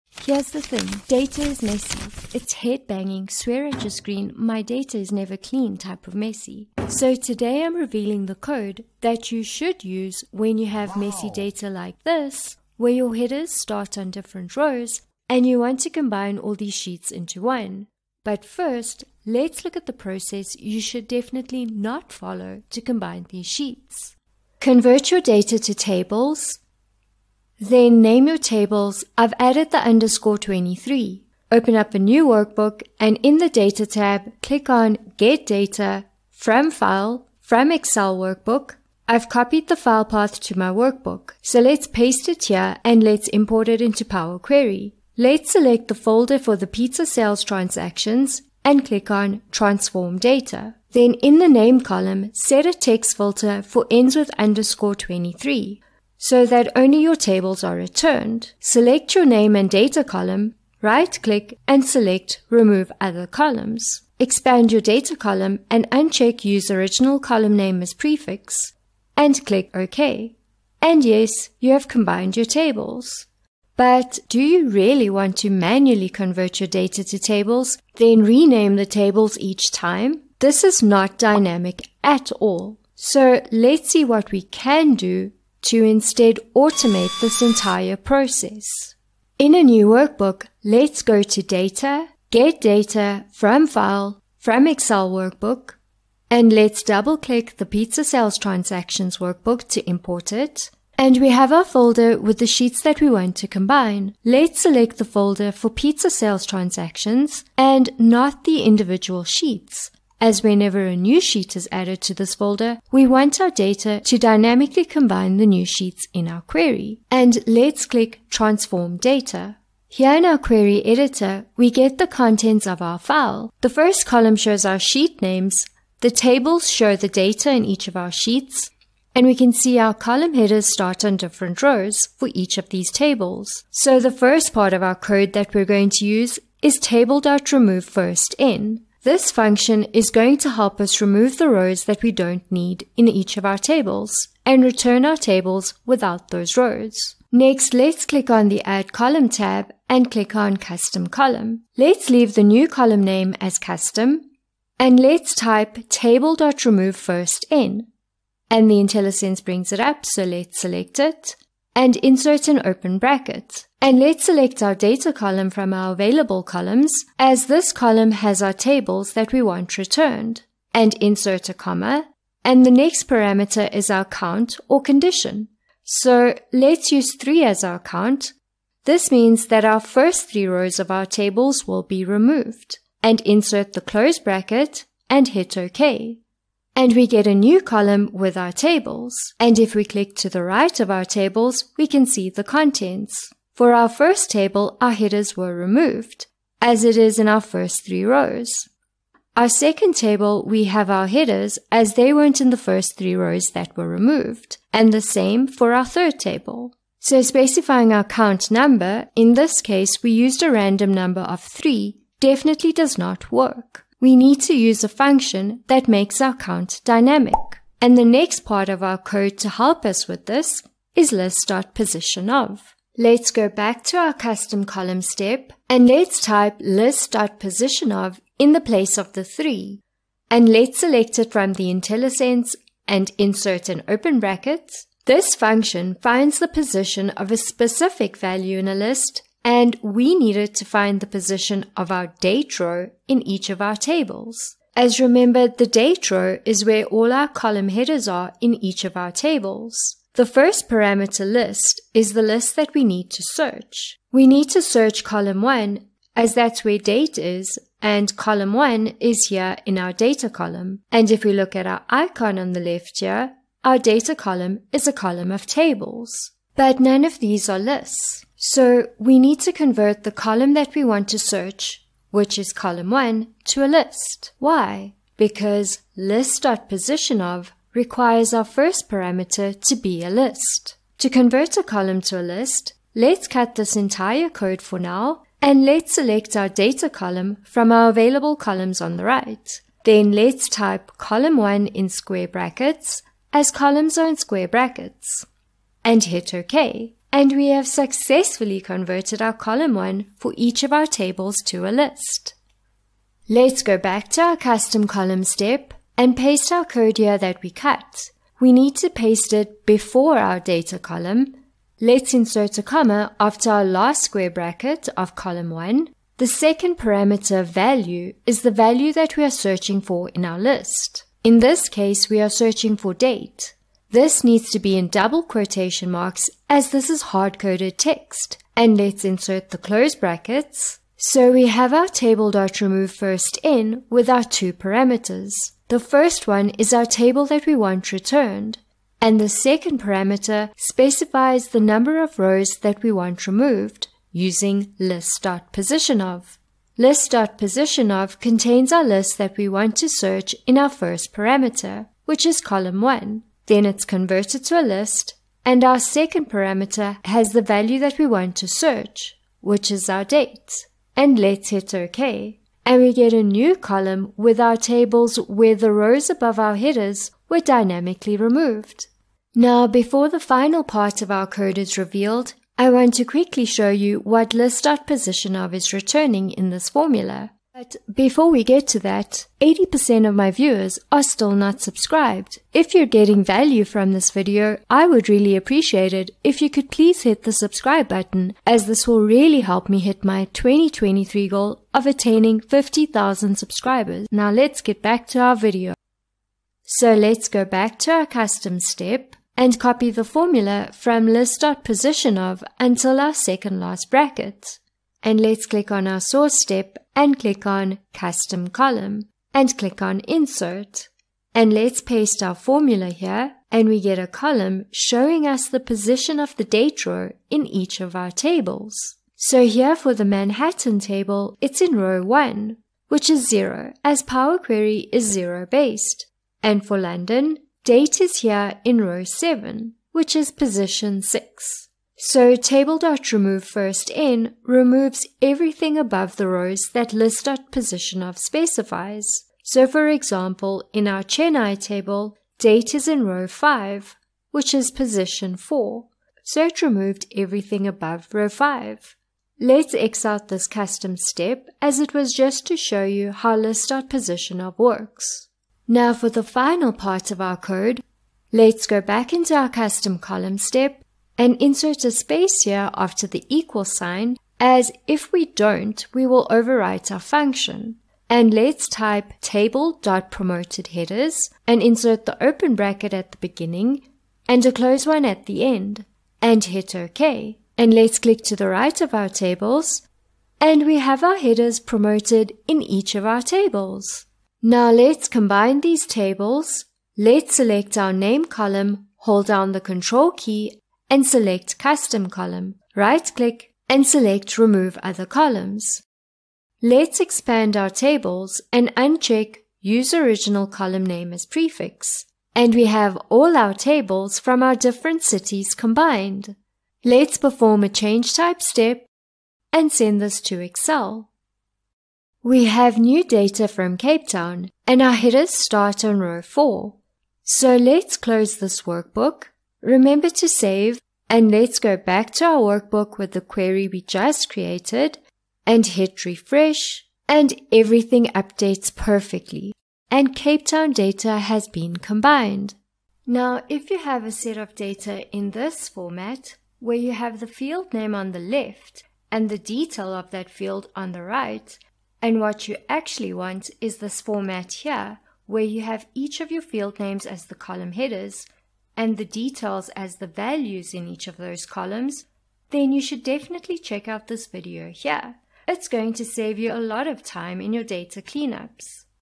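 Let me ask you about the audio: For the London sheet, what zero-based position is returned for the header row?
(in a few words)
6.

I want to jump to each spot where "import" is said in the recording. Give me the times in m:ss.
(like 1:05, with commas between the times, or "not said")
0:43, 1:39.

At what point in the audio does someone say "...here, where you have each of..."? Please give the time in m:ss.
9:04.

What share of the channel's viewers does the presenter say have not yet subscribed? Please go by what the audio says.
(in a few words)
80%.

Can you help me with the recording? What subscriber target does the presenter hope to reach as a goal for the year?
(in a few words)
50,000.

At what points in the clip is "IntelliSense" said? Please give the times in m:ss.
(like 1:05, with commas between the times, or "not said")
2:38, 3:51.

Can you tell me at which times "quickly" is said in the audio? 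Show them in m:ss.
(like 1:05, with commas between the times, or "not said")
6:13.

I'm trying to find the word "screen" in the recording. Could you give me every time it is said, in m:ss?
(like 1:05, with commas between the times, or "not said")
0:03.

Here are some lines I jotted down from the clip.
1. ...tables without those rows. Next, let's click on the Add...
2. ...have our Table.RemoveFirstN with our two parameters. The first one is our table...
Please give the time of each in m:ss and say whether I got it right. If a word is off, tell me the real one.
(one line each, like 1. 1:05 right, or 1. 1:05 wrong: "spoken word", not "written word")
1. 2:25 right
2. 5:31 right.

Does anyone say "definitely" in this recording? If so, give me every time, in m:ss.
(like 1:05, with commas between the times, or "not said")
0:21, 3:32, 9:13.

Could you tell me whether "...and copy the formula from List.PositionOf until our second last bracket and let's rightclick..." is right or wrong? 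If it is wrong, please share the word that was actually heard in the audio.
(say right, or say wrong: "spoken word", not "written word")
wrong: "click", not "rightclick".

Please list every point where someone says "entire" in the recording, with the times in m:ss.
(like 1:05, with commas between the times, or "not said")
1:27, 4:43.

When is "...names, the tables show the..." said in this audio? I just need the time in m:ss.
2:05.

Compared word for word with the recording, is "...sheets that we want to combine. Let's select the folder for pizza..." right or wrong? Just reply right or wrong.
right.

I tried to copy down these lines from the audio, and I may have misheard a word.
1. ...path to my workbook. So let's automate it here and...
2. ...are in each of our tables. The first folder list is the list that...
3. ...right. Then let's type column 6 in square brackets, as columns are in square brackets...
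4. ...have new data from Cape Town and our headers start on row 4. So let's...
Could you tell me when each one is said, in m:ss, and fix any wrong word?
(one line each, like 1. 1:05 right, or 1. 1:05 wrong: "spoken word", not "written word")
1. 0:40 wrong: "paste", not "automate"
2. 4:08 wrong: "parameter", not "folder"
3. 4:49 wrong: "1", not "6"
4. 8:32 right.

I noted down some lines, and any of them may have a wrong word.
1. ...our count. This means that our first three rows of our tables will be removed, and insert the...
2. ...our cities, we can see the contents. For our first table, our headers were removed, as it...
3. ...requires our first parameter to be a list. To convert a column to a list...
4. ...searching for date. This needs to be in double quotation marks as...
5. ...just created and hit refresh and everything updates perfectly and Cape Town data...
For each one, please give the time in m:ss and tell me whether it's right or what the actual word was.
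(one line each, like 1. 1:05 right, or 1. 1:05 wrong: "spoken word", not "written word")
1. 2:57 right
2. 3:10 wrong: "tables", not "cities"
3. 4:37 right
4. 5:22 right
5. 8:43 right.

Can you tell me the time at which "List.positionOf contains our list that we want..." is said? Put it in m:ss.
5:46.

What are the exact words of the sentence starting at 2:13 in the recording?
So the first part of our code that we're going to use is Table.RemoveFirstN.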